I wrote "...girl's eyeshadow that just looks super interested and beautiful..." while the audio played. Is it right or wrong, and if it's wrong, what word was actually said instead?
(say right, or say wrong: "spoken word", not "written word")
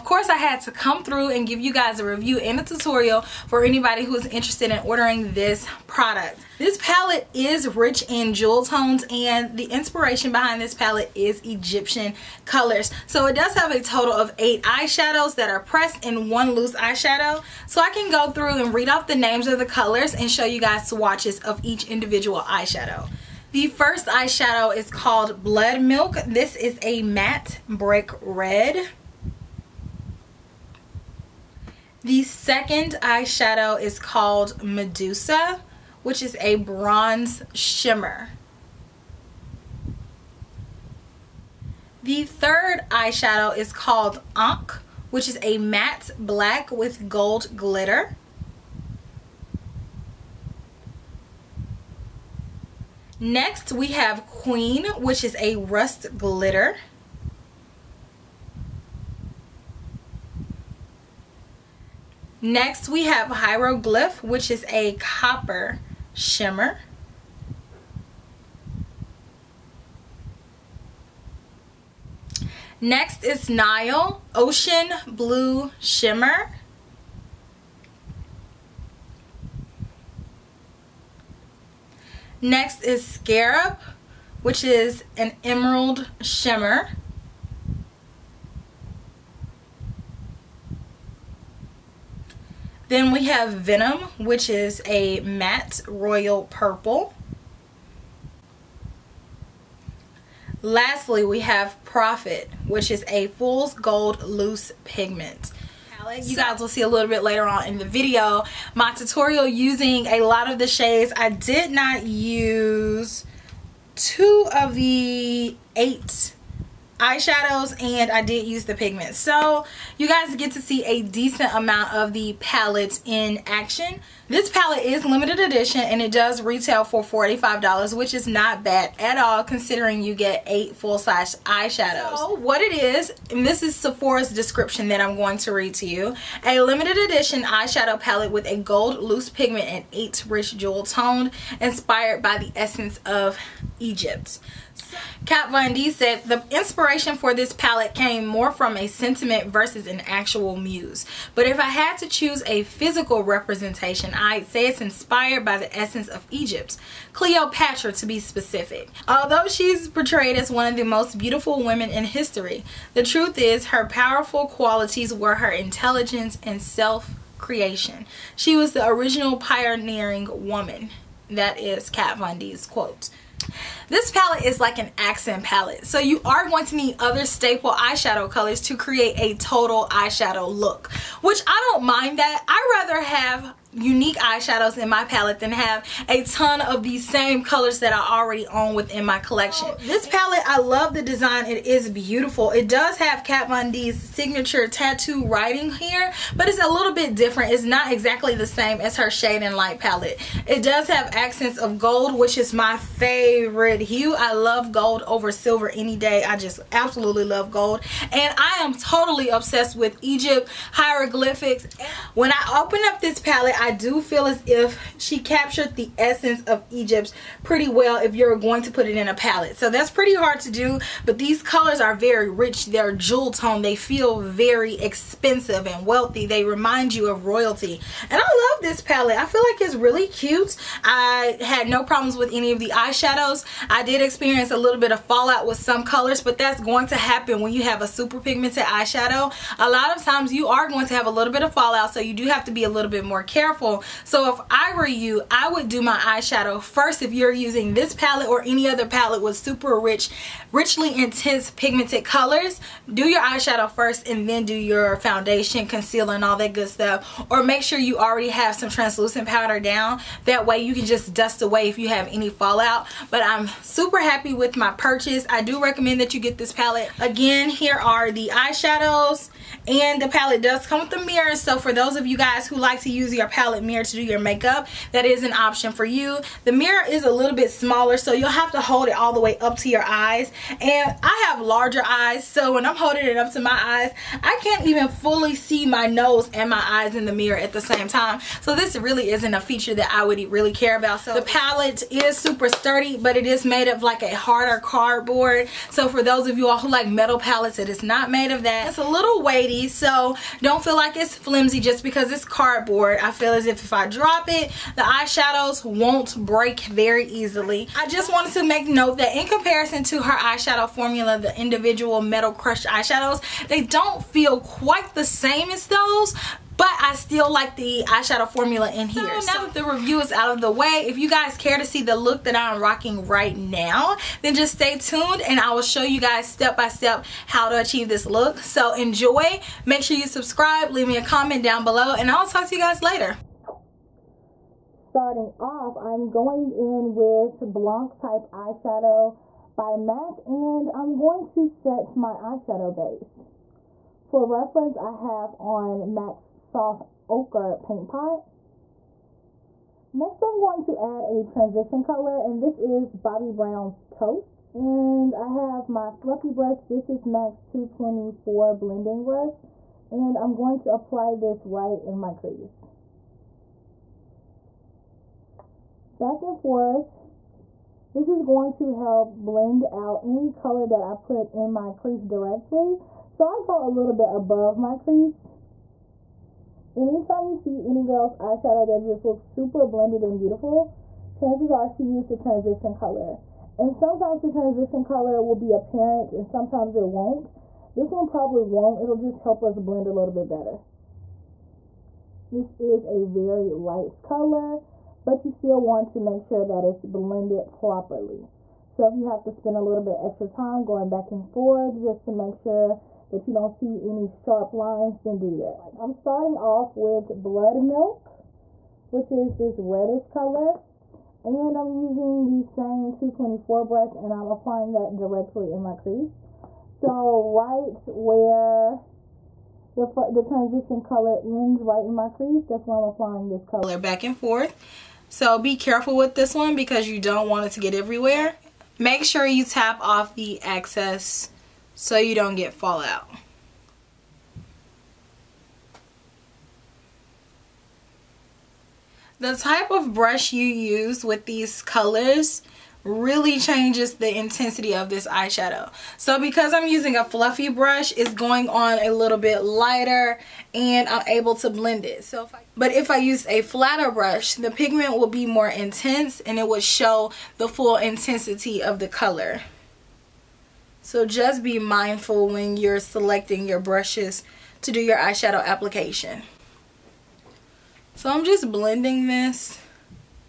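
wrong: "blended", not "interested".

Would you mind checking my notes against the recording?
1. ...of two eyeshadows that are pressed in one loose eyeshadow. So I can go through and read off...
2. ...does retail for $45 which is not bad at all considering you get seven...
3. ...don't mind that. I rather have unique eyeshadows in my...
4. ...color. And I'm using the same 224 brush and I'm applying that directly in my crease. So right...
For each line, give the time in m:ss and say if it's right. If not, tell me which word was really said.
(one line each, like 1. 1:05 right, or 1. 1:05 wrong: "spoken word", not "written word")
1. 0:14 wrong: "eight", not "two"
2. 2:06 wrong: "eight", not "seven"
3. 3:01 right
4. 6:50 right.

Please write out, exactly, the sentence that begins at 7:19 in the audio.
The type of brush you use with these colors really changes the intensity of this eyeshadow.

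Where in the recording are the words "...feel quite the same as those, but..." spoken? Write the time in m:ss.
5:14.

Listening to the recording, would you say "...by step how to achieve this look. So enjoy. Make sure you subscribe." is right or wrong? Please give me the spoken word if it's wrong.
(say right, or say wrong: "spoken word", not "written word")
right.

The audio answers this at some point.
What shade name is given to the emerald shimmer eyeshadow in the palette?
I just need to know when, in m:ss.
1:23.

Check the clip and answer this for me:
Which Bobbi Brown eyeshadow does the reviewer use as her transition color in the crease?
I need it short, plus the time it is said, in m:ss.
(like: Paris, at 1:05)
Toast, at 5:53.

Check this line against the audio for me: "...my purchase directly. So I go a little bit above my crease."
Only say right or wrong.
wrong.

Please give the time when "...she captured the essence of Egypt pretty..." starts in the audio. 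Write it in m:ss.
3:34.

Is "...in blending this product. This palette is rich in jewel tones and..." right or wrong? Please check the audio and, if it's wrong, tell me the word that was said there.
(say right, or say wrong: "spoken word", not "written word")
wrong: "ordering", not "blending".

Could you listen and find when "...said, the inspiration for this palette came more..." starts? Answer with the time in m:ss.
2:25.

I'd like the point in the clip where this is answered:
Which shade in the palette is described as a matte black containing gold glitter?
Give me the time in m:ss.
0:44.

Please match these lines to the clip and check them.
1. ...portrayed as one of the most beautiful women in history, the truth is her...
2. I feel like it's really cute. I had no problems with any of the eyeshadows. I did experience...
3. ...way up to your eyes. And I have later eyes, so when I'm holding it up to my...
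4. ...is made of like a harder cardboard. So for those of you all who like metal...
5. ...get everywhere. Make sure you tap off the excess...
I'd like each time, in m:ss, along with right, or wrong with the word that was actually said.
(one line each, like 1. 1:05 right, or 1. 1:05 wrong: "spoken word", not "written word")
1. 2:39 right
2. 3:49 right
3. 4:39 wrong: "larger", not "later"
4. 4:53 right
5. 7:07 right.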